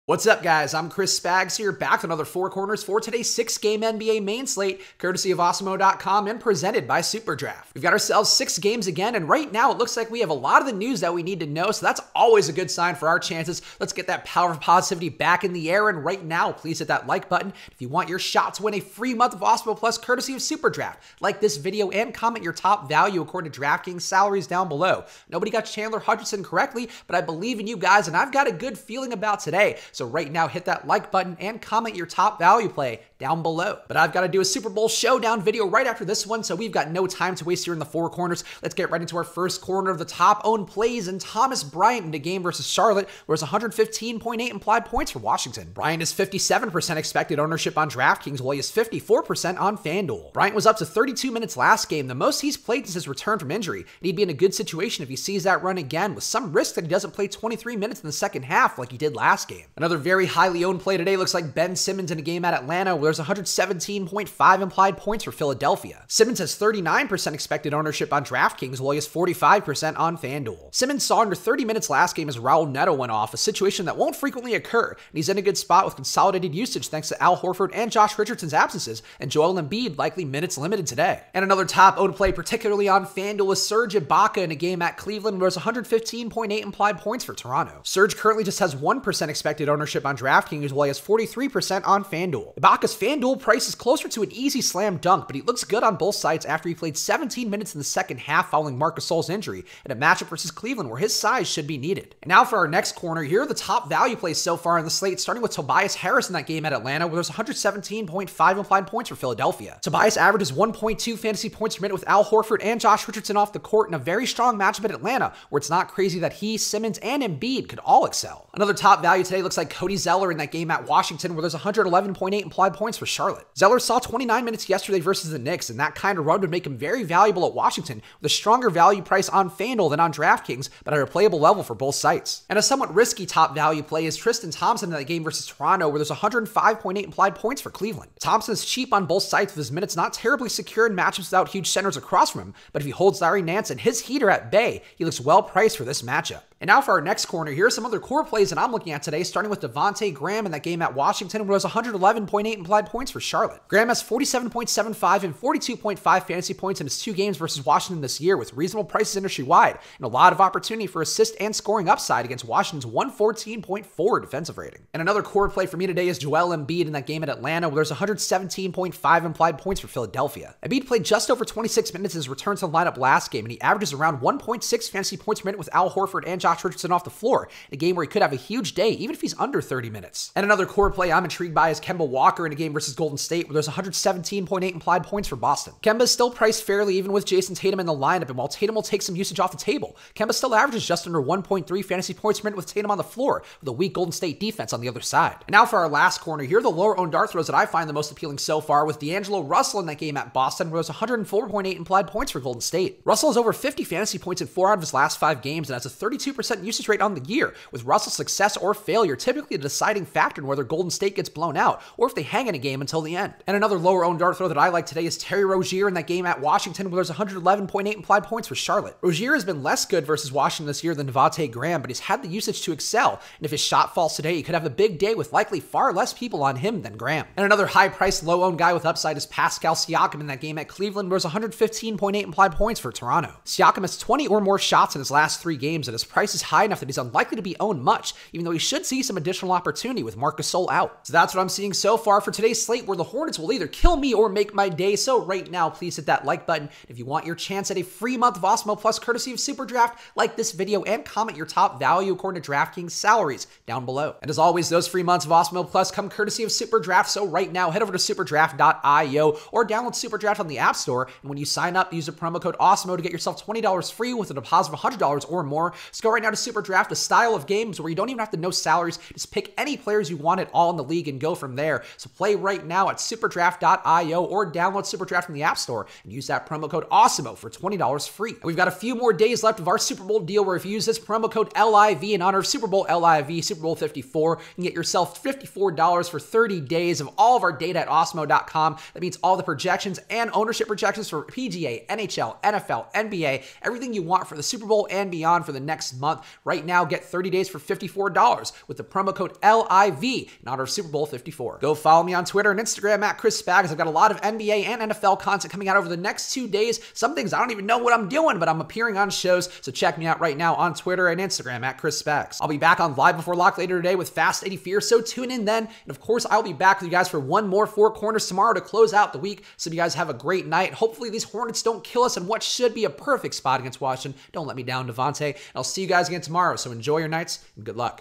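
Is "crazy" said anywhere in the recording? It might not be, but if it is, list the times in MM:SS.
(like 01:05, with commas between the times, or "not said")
01:55.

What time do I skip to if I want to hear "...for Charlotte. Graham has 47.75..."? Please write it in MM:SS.
02:33.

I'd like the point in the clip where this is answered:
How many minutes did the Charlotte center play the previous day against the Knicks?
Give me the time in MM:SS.
02:03.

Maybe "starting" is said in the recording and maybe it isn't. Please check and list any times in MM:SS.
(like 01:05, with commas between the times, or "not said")
01:45, 02:29.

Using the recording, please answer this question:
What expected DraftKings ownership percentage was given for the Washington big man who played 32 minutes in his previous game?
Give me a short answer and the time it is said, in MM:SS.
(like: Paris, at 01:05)
57%, at 00:46.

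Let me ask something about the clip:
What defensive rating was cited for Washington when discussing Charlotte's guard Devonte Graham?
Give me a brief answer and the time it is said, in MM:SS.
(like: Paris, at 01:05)
114.4, at 02:42.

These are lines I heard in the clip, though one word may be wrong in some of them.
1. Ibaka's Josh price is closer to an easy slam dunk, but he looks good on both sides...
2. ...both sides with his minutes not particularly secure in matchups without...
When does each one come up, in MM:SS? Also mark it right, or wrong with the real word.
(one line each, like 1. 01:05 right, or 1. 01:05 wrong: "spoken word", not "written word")
1. 01:32 wrong: "FanDuel", not "Josh"
2. 02:19 wrong: "terribly", not "particularly".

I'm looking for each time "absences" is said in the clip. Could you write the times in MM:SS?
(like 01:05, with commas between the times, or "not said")
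01:18.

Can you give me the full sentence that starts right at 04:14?
And as always, those free months of Awesemo Plus come courtesy of Superdraft.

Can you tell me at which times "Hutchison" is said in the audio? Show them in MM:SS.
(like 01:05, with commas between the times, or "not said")
00:26.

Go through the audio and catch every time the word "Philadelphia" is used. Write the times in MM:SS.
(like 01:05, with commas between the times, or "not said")
01:05, 01:49, 02:49.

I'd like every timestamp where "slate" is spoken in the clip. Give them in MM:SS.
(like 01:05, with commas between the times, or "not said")
00:04, 01:44, 04:02.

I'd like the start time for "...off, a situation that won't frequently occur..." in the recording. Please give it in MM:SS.
01:13.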